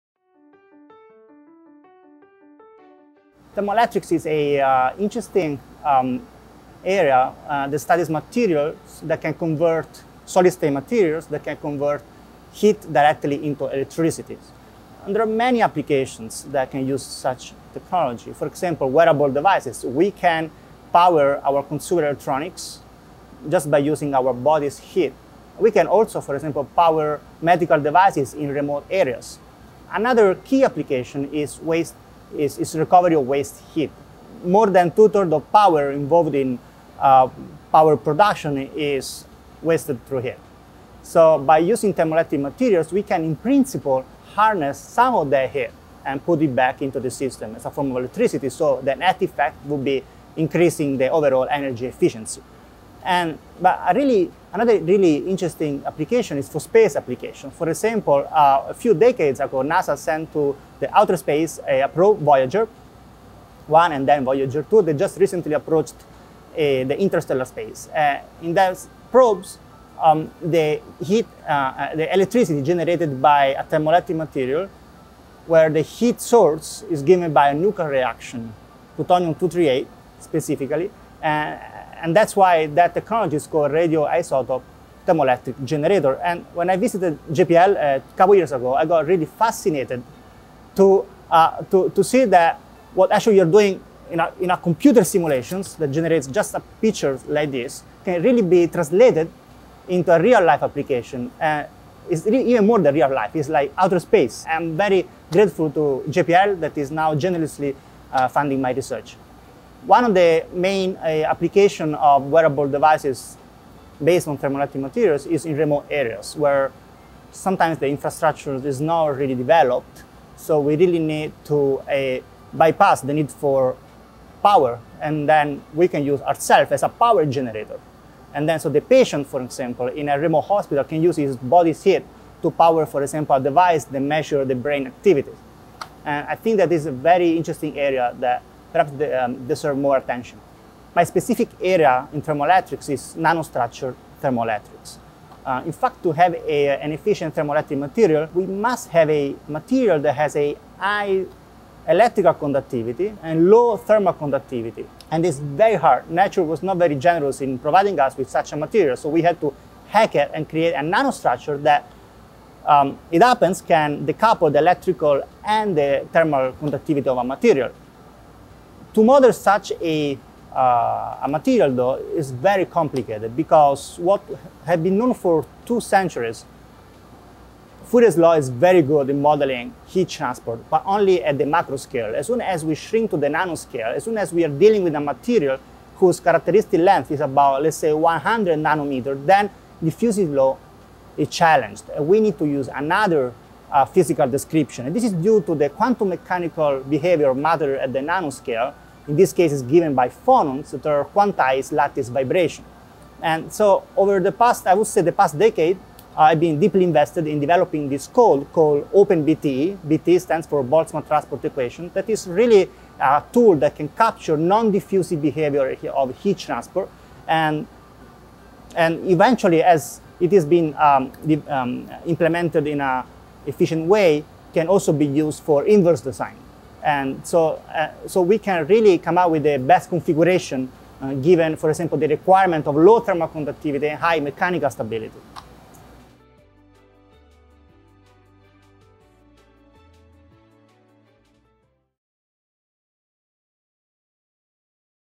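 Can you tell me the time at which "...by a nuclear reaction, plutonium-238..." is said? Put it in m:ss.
1:17.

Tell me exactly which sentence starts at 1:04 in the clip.
They just recently approached uh, the interstellar space.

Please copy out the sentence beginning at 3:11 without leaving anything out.
We need to use another uh, physical description.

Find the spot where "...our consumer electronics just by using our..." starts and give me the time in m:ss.
0:21.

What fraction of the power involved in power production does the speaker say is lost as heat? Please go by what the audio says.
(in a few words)
More than two-thirds.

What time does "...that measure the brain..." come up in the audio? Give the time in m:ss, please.
2:13.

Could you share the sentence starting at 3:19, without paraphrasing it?
In this case, is given by phonons that are quantized lattice vibration.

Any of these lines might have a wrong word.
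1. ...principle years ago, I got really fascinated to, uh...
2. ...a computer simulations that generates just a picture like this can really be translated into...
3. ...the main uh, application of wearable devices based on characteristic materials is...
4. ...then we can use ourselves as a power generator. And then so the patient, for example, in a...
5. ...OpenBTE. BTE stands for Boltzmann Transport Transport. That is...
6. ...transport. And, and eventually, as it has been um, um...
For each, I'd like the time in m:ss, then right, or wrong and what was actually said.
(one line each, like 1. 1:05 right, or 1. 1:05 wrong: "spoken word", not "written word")
1. 1:28 wrong: "couple", not "principle"
2. 1:34 right
3. 1:50 wrong: "thermoelectric", not "characteristic"
4. 2:05 right
5. 3:28 wrong: "Equation", not "Transport"
6. 3:36 right.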